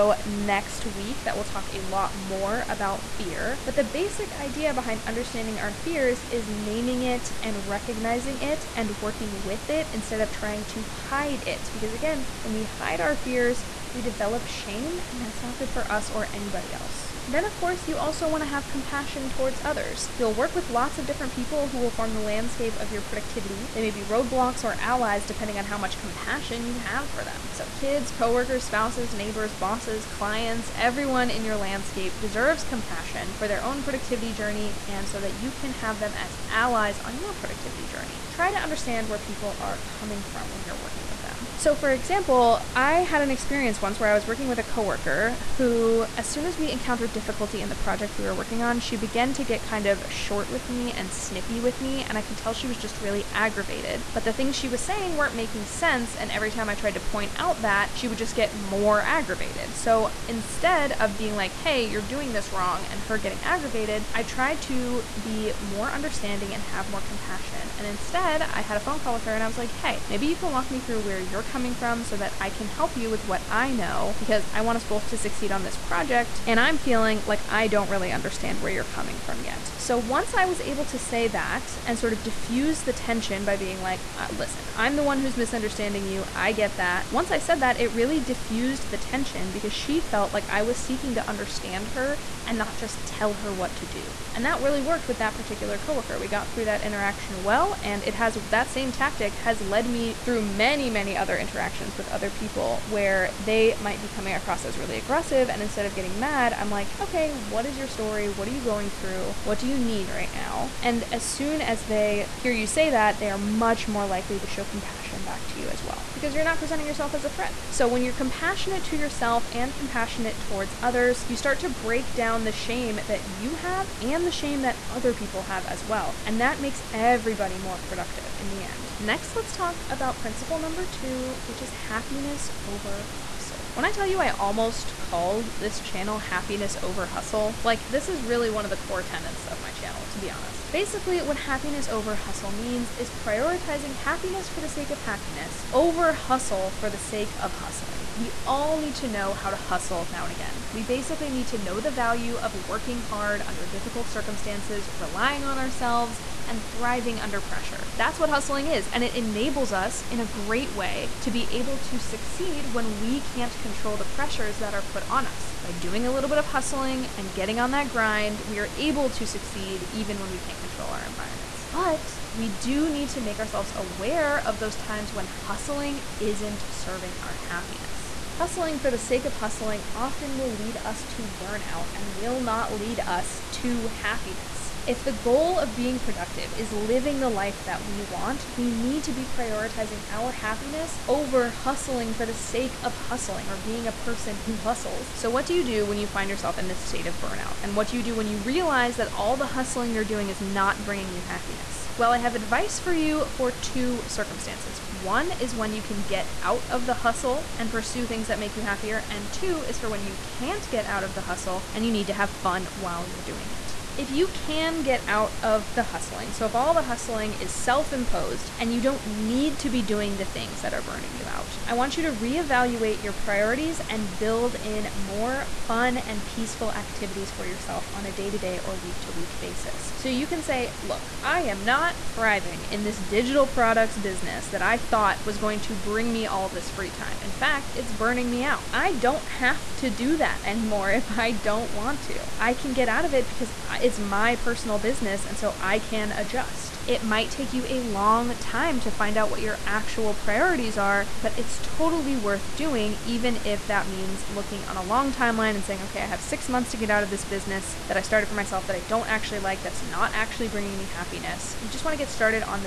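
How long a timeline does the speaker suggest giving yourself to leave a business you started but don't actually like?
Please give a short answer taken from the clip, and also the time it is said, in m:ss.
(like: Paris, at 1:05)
6 months, at 4:16.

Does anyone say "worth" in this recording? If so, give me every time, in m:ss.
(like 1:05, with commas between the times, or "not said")
4:12.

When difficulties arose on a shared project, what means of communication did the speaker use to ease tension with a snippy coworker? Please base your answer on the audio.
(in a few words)
A phone call.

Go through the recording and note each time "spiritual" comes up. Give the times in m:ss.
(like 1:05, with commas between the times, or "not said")
not said.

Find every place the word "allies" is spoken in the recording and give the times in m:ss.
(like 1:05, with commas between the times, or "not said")
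0:24, 0:36.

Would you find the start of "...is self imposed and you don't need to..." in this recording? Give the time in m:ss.
3:37.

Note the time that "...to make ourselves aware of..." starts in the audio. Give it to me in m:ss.
2:53.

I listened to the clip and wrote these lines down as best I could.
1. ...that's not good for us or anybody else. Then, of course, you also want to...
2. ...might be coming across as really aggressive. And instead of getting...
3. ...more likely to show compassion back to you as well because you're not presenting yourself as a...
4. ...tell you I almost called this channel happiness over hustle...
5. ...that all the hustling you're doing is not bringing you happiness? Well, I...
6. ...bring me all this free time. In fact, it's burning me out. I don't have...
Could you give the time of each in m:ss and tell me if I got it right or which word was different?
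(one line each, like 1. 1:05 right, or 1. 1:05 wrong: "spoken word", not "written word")
1. 0:15 right
2. 1:43 right
3. 1:53 right
4. 2:13 right
5. 3:18 right
6. 3:55 right.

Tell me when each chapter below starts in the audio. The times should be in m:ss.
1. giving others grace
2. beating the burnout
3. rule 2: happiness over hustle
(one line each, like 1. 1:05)
1. 0:41
2. 3:14
3. 2:08.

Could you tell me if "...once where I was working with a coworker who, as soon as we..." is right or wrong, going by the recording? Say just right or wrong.
right.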